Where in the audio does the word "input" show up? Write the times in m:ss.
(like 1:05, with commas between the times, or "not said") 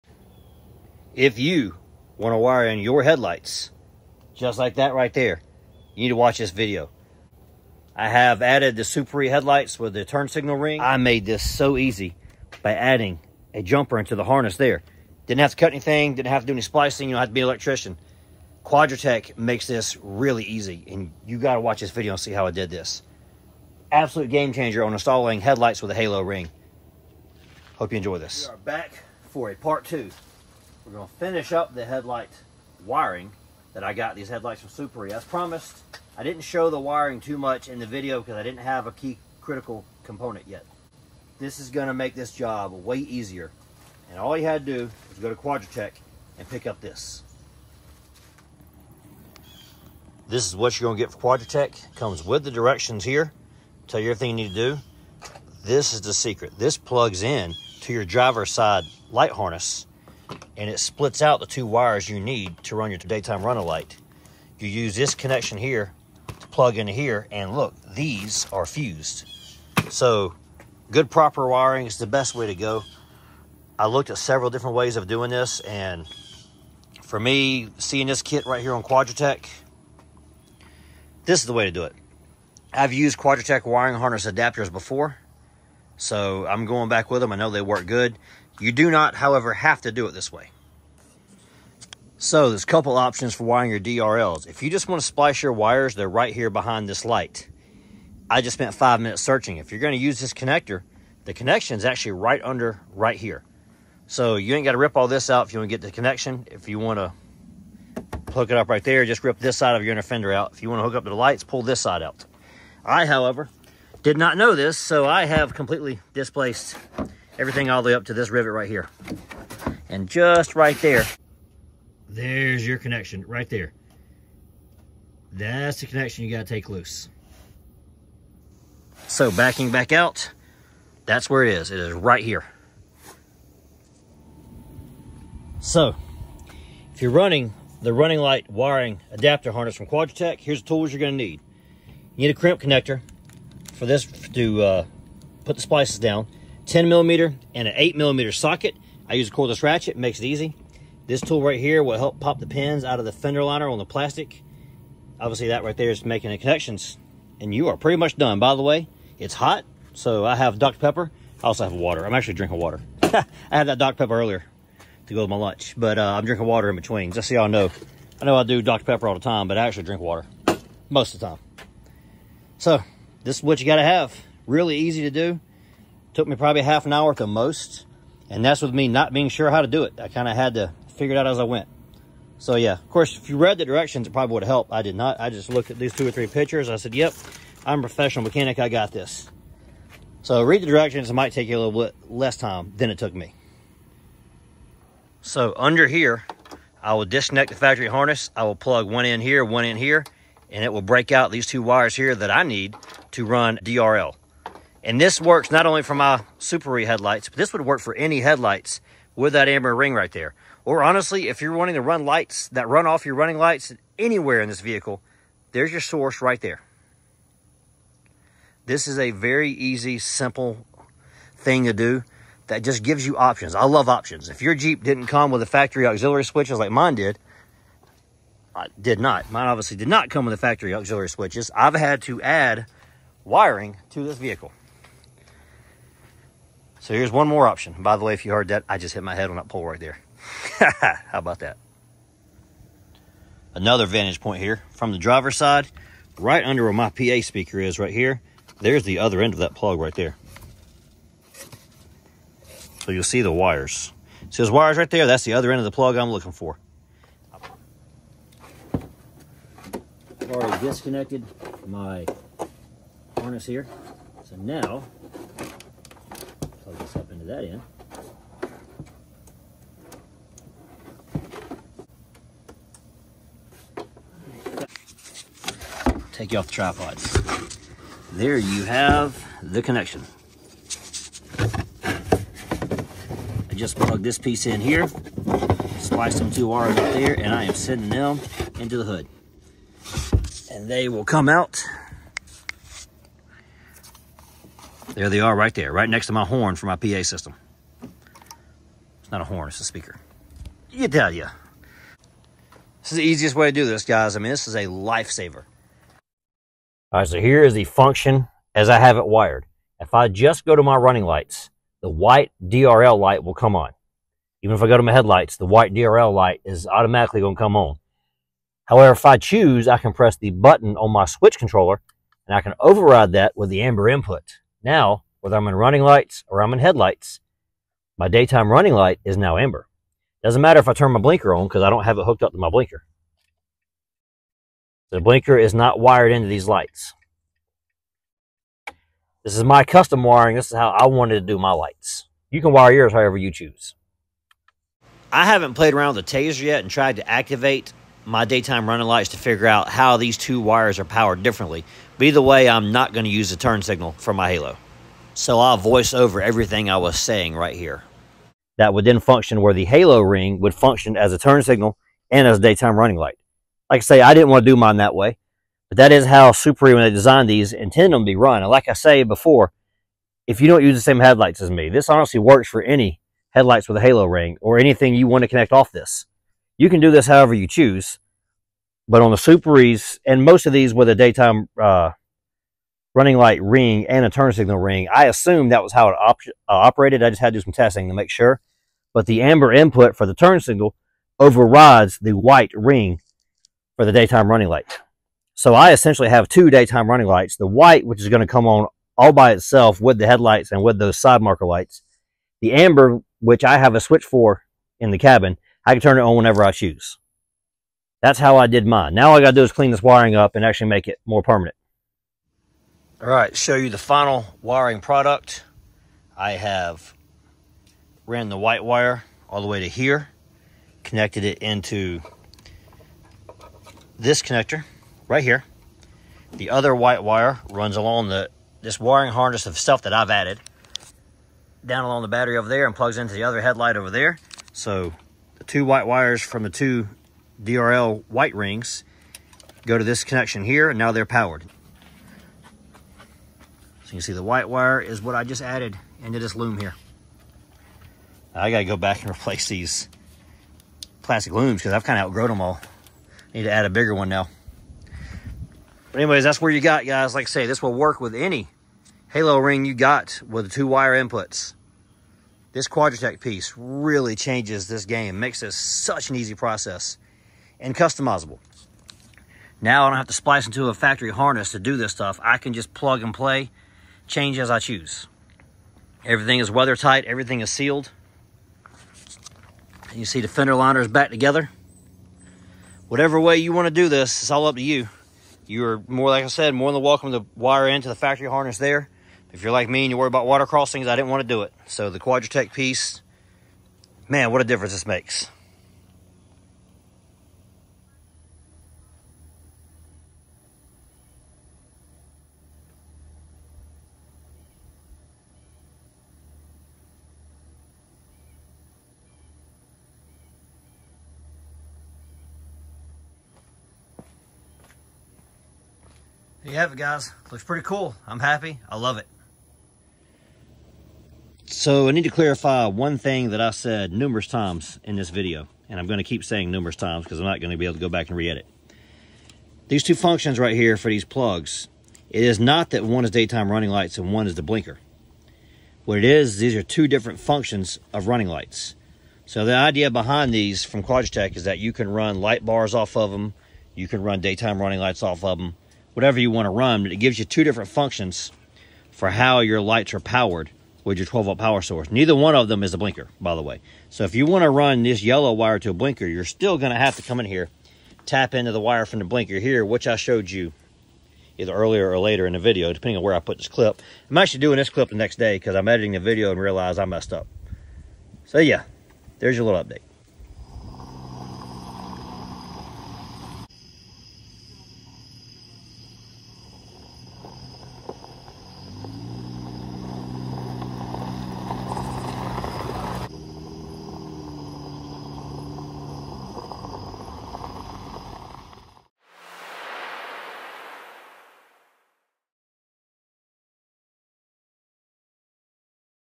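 5:23, 6:29, 7:40.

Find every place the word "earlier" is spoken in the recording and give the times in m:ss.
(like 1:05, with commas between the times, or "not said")
2:44, 9:21.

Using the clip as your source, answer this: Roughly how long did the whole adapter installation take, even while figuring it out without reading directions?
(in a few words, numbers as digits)
Half an hour.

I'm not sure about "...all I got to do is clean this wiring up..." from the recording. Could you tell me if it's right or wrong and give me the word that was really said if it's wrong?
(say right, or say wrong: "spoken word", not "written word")
right.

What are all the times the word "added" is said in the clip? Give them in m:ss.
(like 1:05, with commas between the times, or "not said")
0:08, 7:10, 7:25.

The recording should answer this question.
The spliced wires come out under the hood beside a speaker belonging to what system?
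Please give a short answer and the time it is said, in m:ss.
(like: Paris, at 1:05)
PA system, at 4:56.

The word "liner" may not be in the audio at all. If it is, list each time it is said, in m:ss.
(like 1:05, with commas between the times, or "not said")
2:33, 8:00.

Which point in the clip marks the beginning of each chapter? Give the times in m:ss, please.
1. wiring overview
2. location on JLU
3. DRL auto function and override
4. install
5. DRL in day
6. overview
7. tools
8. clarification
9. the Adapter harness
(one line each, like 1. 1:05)
1. 6:55
2. 1:30
3. 5:00
4. 4:15
5. 8:20
6. 3:15
7. 2:15
8. 8:40
9. 0:30.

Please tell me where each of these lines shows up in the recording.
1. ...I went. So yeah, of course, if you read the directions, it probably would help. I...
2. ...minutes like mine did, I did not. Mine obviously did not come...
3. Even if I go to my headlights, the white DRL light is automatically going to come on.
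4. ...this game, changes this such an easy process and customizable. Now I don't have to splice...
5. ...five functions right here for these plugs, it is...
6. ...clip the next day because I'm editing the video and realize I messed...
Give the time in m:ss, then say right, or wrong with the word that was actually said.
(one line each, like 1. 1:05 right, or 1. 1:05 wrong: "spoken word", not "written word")
1. 3:01 right
2. 3:46 wrong: "switches", not "minutes"
3. 5:14 right
4. 7:44 wrong: "makes", not "changes"
5. 8:49 wrong: "two", not "five"
6. 9:24 right.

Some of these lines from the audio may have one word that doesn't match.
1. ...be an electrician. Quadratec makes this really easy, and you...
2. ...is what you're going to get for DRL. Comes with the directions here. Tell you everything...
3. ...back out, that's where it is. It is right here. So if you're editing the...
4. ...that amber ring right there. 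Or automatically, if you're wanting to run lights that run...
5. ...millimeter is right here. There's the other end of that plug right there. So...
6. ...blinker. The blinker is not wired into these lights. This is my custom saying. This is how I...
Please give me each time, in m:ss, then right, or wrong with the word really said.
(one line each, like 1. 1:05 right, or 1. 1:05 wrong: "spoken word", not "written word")
1. 0:17 right
2. 0:50 wrong: "Quadratec", not "DRL"
3. 2:09 wrong: "running", not "editing"
4. 3:29 wrong: "honestly", not "automatically"
5. 4:07 wrong: "speaker", not "millimeter"
6. 5:32 wrong: "wiring", not "saying".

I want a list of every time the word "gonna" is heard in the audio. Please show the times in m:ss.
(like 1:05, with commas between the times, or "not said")
2:20.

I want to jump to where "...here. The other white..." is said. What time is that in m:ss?
7:05.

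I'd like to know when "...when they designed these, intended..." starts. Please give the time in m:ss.
6:06.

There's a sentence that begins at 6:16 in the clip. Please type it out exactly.
You can do this however you choose.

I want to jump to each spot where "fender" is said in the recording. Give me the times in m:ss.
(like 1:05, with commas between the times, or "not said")
1:50, 2:33, 8:00.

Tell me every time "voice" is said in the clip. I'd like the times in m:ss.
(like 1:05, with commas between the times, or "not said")
5:55.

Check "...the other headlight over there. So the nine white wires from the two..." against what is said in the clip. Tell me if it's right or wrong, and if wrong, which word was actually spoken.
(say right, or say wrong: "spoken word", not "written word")
wrong: "two", not "nine".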